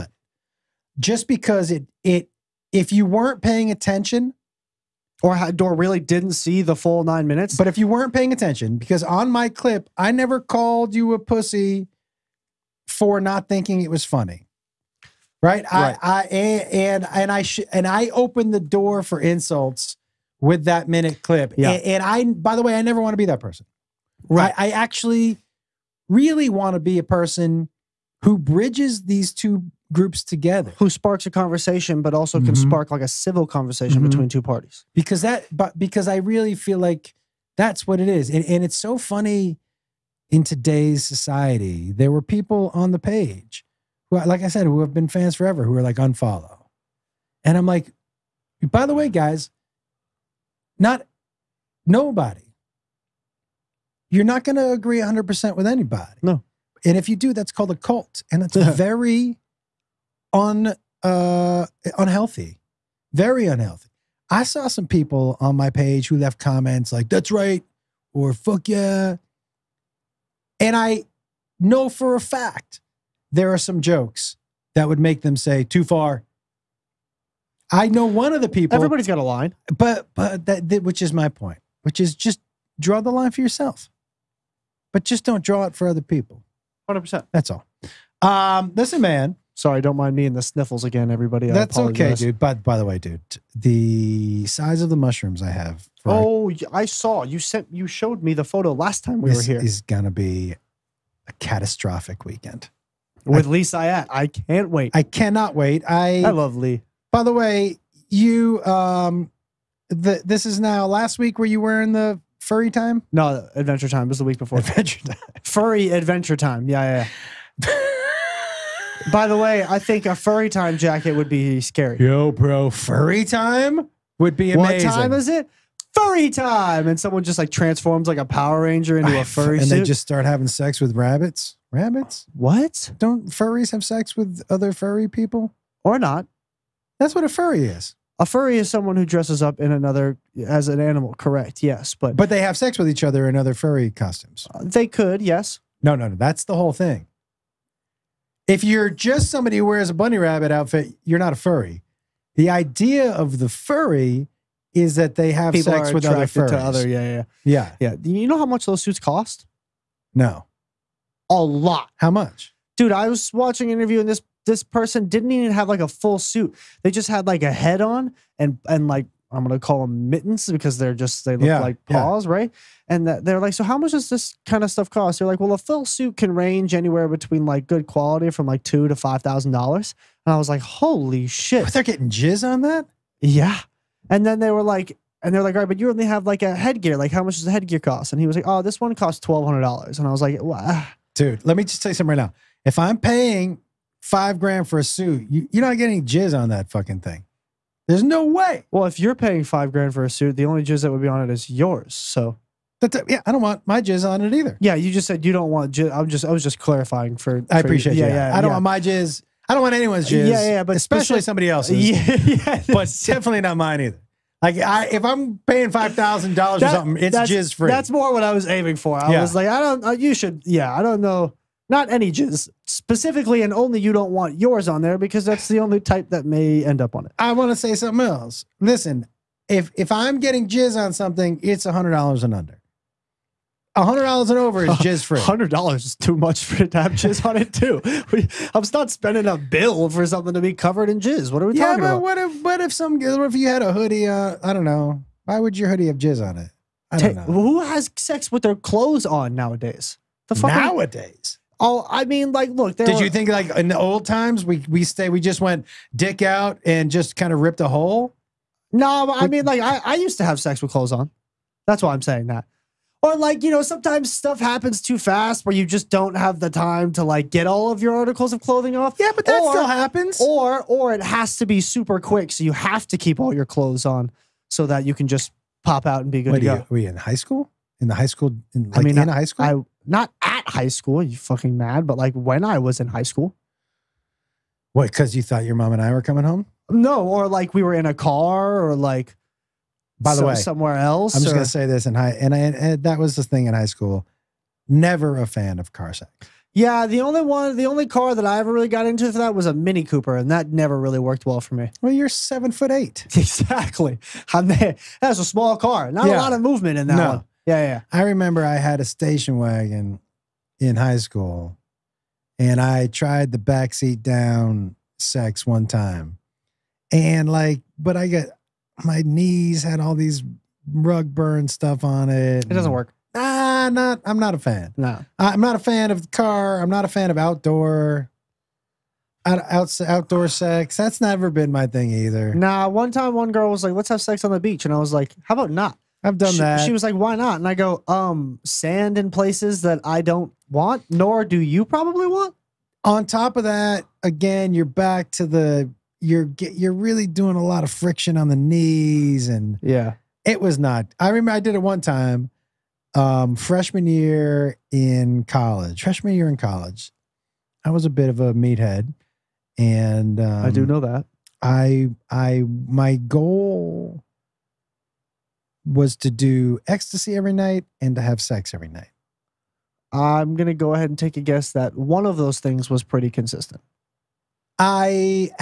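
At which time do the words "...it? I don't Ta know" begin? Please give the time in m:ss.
4:06.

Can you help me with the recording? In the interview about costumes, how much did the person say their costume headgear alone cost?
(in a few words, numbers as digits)
$1,200.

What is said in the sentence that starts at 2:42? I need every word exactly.
dude, I was watching an interview and this this person didn't even have like a full suit.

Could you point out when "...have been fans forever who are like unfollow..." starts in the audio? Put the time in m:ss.
0:44.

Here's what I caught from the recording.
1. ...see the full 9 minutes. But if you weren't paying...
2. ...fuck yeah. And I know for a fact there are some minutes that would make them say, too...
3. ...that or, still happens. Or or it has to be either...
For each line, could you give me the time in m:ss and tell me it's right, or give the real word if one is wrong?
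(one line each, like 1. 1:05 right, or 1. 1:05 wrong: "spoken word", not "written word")
1. 0:06 right
2. 1:08 wrong: "jokes", not "minutes"
3. 4:29 wrong: "super", not "either".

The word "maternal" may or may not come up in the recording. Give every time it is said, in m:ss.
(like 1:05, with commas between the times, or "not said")
not said.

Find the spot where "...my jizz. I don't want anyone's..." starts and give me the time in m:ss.
3:28.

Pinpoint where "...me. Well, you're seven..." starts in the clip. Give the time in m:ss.
5:01.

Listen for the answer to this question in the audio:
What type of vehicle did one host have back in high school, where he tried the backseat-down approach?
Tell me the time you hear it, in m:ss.
5:08.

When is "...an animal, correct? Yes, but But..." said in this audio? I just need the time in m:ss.
2:20.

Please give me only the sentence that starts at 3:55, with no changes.
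Hundred dollars is too much for it to have jizz on it too.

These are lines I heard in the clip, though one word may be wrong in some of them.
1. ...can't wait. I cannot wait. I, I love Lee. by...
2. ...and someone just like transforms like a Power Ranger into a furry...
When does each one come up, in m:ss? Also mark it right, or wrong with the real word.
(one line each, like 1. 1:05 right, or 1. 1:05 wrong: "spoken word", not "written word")
1. 1:44 right
2. 2:06 right.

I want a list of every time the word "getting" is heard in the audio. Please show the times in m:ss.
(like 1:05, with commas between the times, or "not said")
3:01, 3:15, 3:50.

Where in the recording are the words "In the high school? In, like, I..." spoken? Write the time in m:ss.
4:37.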